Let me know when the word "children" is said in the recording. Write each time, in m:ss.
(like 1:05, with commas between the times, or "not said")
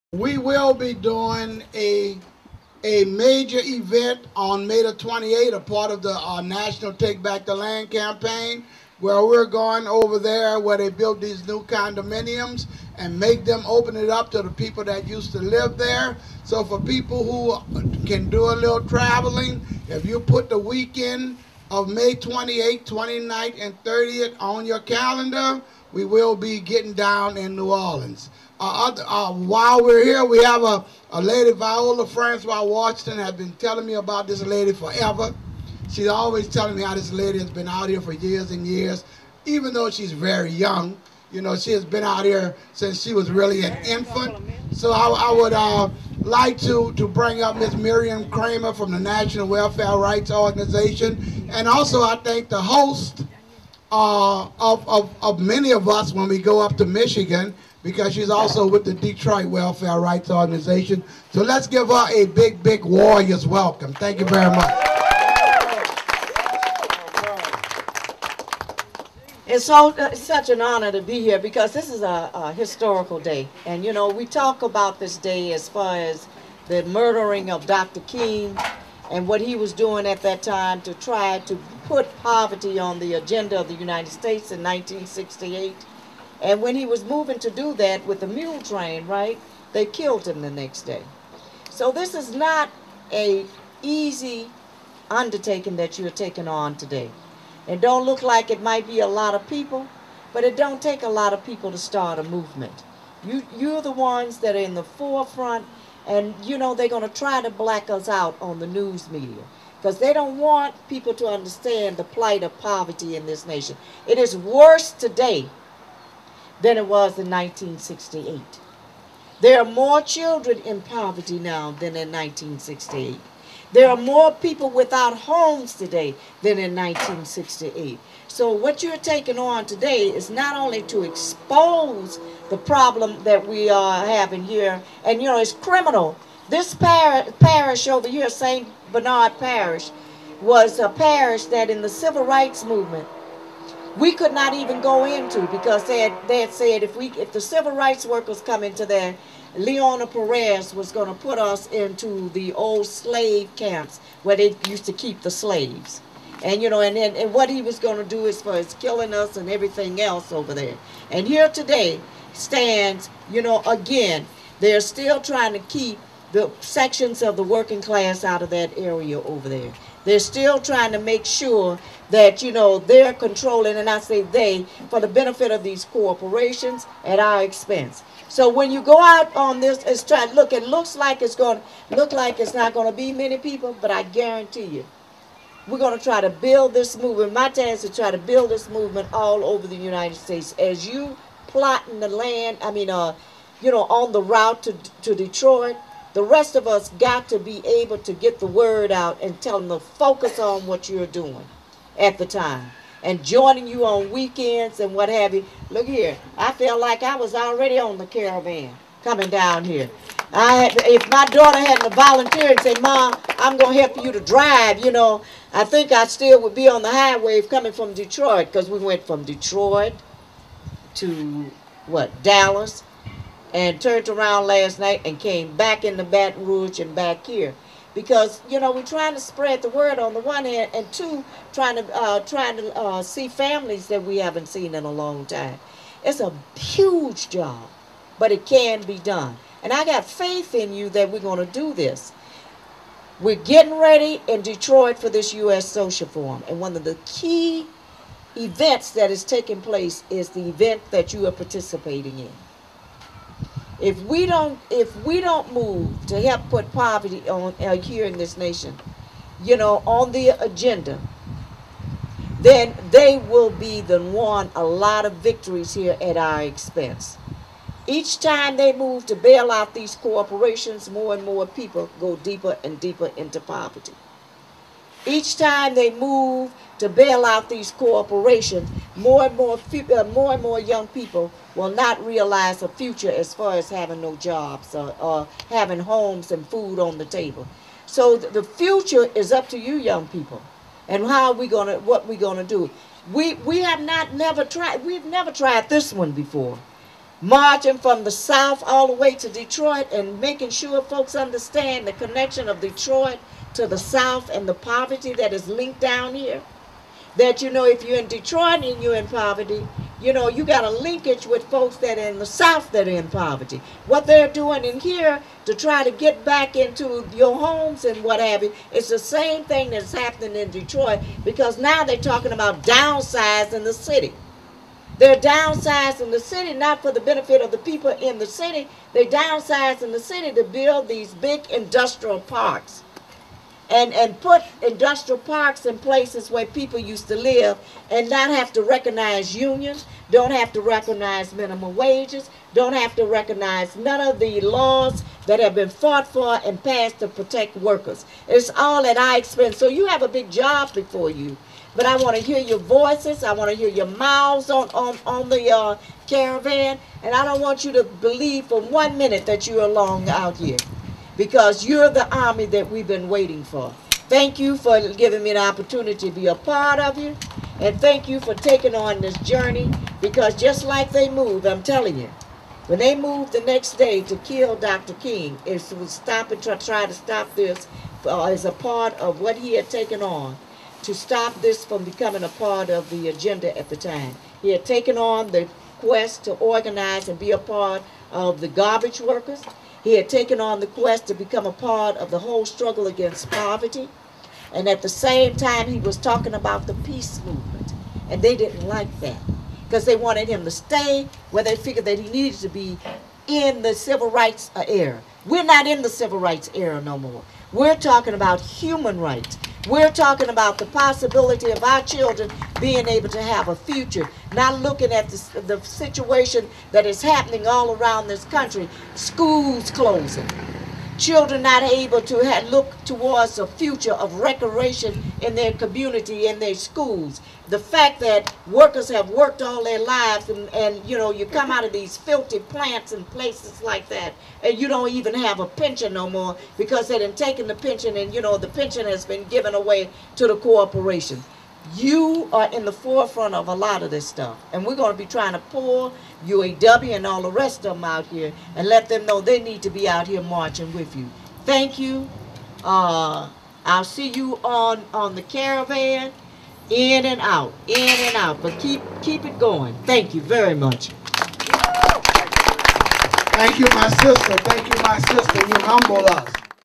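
2:00, 6:51, 7:01.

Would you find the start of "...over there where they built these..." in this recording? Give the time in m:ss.
0:09.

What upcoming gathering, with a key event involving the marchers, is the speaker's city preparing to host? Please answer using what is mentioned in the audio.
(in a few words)
U.S. Social Forum.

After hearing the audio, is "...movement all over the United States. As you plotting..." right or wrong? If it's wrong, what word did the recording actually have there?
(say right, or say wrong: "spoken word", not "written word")
right.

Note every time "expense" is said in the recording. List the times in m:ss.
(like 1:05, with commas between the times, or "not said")
2:57, 4:26, 5:49.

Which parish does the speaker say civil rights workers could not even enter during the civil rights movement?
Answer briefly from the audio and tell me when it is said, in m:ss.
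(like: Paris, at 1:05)
St. Bernard Parish, at 2:18.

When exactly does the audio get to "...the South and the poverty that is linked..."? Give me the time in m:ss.
5:03.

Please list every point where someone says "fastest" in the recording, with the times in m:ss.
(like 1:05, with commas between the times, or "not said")
not said.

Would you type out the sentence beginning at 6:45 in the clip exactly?
We're not in the civil rights era no more.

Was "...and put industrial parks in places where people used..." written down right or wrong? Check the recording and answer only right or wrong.
right.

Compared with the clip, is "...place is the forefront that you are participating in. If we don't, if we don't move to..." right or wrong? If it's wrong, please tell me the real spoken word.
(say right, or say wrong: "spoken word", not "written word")
wrong: "event", not "forefront".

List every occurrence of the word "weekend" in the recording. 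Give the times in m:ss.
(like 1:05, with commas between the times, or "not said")
0:20, 3:24.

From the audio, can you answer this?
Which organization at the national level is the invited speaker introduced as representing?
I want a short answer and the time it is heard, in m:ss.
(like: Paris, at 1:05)
National Welfare Rights Organization, at 0:48.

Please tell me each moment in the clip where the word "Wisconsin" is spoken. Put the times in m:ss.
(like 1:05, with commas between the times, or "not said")
not said.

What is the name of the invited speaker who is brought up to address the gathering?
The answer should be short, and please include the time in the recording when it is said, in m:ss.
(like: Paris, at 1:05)
Marian Kramer, at 0:47.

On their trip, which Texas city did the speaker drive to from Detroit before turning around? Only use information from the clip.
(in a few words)
Dallas.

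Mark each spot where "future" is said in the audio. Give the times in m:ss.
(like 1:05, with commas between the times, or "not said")
4:42, 4:48, 6:53, 7:03.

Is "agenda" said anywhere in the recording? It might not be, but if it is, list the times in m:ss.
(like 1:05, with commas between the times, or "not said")
1:23, 4:20, 6:23.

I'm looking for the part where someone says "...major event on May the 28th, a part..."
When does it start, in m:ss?
0:03.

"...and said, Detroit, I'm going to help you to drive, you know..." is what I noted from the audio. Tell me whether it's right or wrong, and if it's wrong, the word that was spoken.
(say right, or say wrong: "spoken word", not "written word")
wrong: "Mom", not "Detroit".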